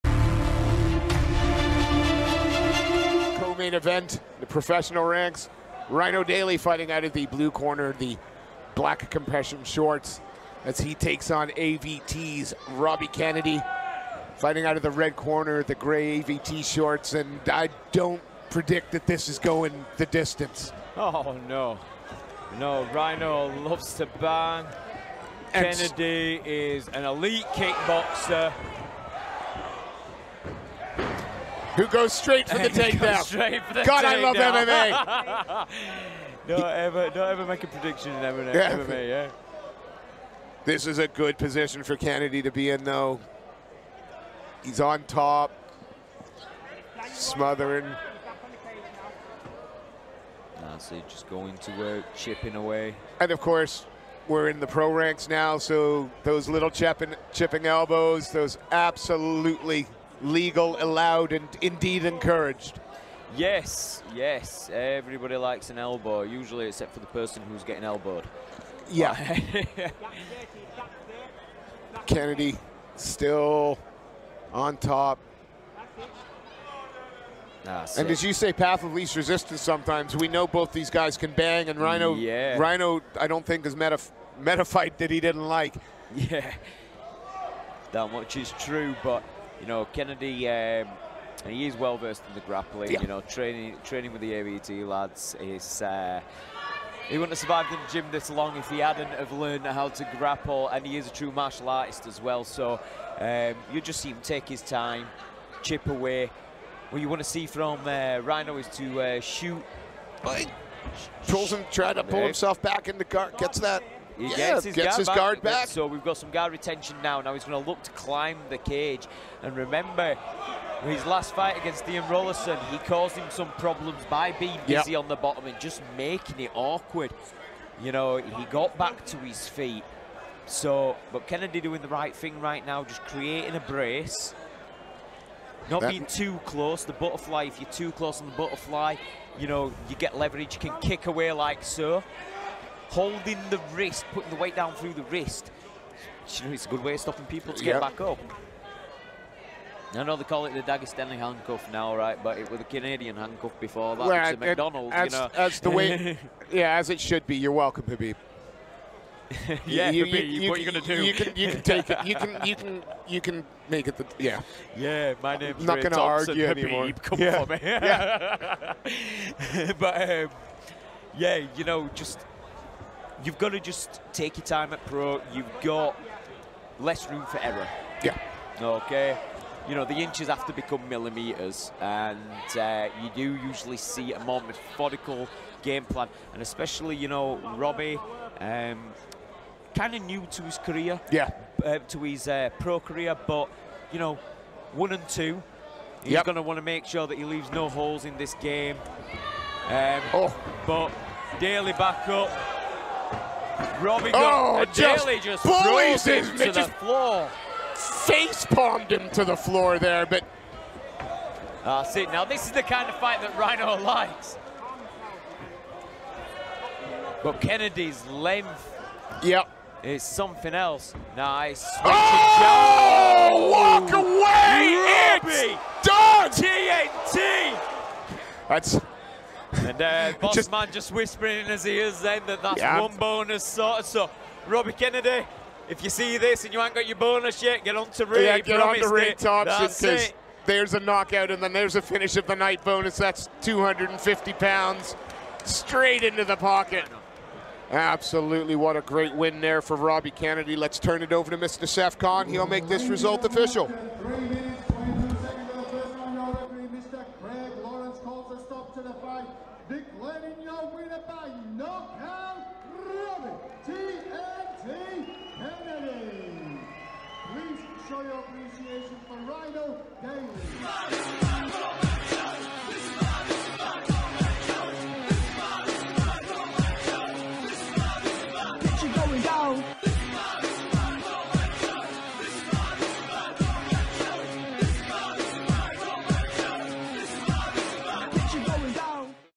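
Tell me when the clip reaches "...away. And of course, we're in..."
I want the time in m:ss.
0:52.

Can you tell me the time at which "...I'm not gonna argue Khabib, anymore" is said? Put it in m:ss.
2:45.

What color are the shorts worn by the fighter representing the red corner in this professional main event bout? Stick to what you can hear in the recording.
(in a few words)
Gray.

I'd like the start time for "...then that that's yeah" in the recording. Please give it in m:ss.
3:52.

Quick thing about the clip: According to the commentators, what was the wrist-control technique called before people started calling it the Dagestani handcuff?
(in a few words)
Canadian handcuff.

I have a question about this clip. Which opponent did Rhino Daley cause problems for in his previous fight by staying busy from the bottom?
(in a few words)
Ian Rollison.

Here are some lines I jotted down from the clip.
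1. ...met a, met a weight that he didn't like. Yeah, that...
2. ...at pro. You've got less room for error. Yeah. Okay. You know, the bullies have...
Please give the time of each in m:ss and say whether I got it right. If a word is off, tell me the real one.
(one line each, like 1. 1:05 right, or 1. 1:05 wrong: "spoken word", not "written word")
1. 1:23 wrong: "fight", not "weight"
2. 2:54 wrong: "inches", not "bullies".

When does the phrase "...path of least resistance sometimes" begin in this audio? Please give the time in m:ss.
1:18.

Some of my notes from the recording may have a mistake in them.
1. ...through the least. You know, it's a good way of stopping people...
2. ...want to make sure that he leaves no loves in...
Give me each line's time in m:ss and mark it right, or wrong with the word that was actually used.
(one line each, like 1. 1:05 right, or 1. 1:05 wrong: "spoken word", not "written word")
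1. 2:24 wrong: "wrist", not "least"
2. 3:16 wrong: "holes", not "loves".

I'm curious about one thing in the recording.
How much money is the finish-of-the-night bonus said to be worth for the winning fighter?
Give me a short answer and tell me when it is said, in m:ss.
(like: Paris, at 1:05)
250 pounds, at 4:03.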